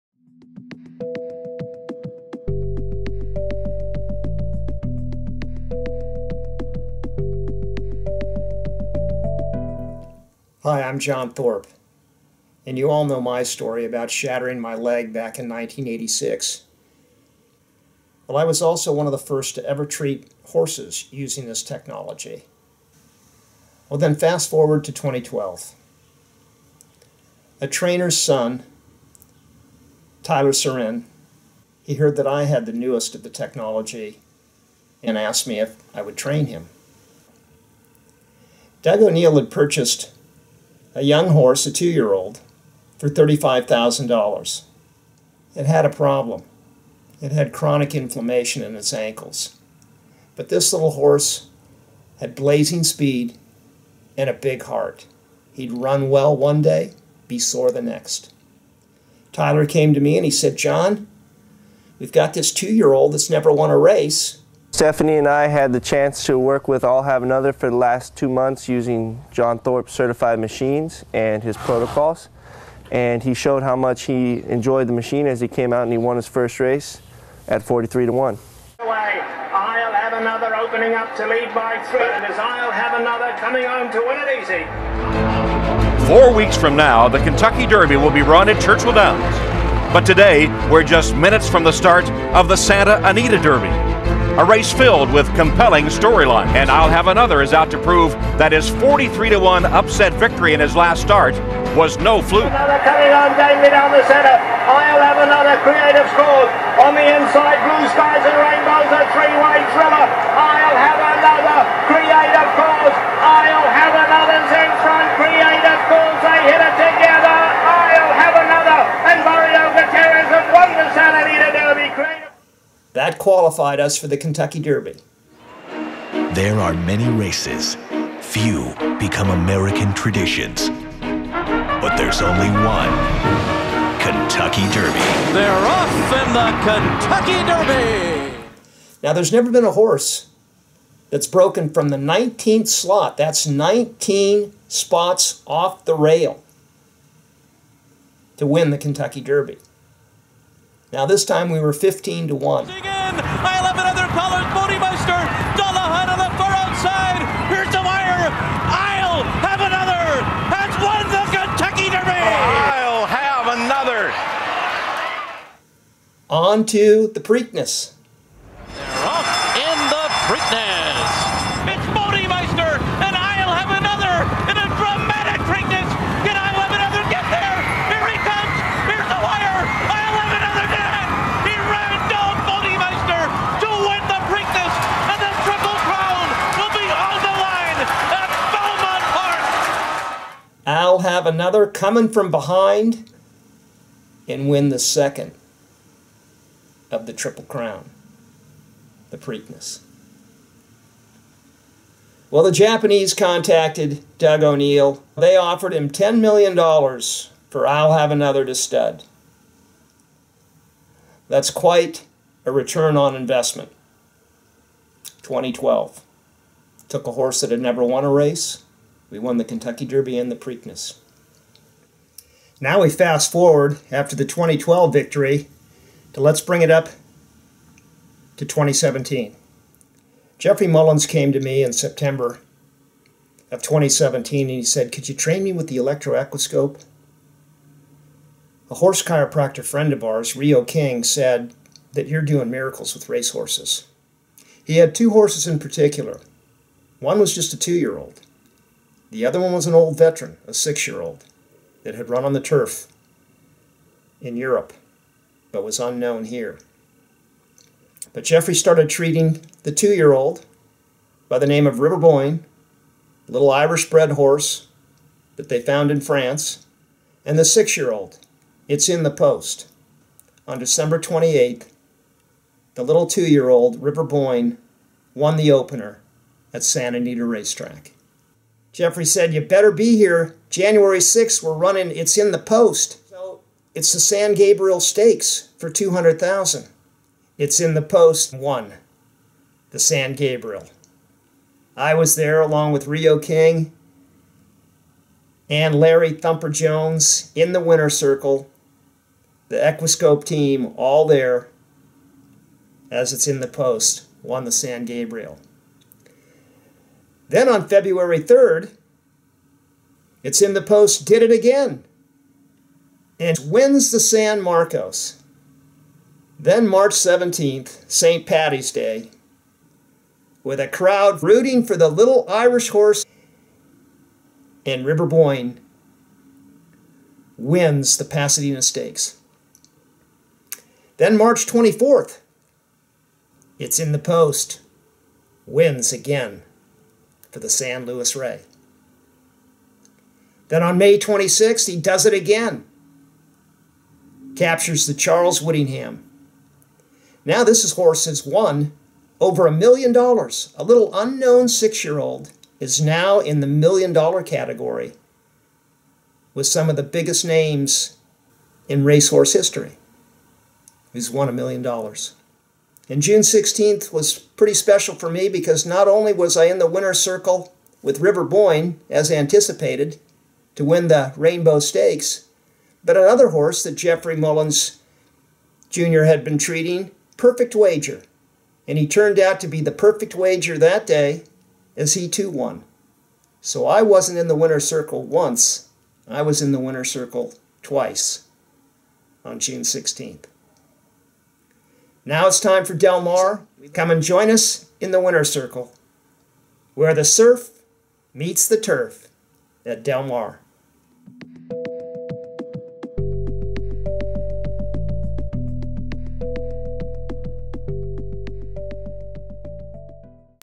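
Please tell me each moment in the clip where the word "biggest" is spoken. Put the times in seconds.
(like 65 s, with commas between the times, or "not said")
356 s.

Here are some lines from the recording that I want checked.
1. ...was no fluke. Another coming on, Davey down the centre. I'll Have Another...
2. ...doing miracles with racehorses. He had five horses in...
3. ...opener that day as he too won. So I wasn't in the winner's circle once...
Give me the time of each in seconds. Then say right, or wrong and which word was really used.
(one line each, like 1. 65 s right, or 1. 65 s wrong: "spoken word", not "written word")
1. 101 s right
2. 242 s wrong: "two", not "five"
3. 380 s wrong: "wager", not "opener".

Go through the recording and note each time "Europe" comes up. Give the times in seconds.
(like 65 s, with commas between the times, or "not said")
254 s.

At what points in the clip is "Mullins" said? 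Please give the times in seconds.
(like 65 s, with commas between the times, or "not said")
230 s, 374 s.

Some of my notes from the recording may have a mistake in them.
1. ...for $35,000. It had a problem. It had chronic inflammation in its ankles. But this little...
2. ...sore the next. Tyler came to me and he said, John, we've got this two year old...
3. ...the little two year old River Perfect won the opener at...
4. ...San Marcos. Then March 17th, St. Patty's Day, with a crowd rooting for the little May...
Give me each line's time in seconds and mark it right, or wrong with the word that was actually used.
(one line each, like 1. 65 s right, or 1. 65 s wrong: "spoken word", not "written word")
1. 42 s right
2. 57 s right
3. 272 s wrong: "Boyne", not "Perfect"
4. 313 s wrong: "Irish", not "May".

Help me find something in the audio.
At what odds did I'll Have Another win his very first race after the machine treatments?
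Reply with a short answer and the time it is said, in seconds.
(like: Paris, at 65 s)
43 to 1, at 77 s.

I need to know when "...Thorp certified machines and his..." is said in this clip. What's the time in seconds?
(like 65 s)
69 s.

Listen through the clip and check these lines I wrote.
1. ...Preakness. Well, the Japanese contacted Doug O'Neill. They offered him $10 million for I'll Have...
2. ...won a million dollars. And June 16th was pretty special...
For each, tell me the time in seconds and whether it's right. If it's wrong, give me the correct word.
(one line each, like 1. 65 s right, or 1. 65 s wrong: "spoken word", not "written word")
1. 199 s right
2. 361 s right.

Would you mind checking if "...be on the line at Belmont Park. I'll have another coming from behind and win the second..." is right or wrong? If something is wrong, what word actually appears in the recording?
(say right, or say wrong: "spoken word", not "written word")
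right.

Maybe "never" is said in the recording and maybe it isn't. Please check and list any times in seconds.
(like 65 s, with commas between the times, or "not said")
63 s, 139 s, 217 s.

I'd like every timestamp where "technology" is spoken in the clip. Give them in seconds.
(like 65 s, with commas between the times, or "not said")
21 s, 33 s.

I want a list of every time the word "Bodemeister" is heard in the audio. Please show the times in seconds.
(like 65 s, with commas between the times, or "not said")
171 s, 182 s.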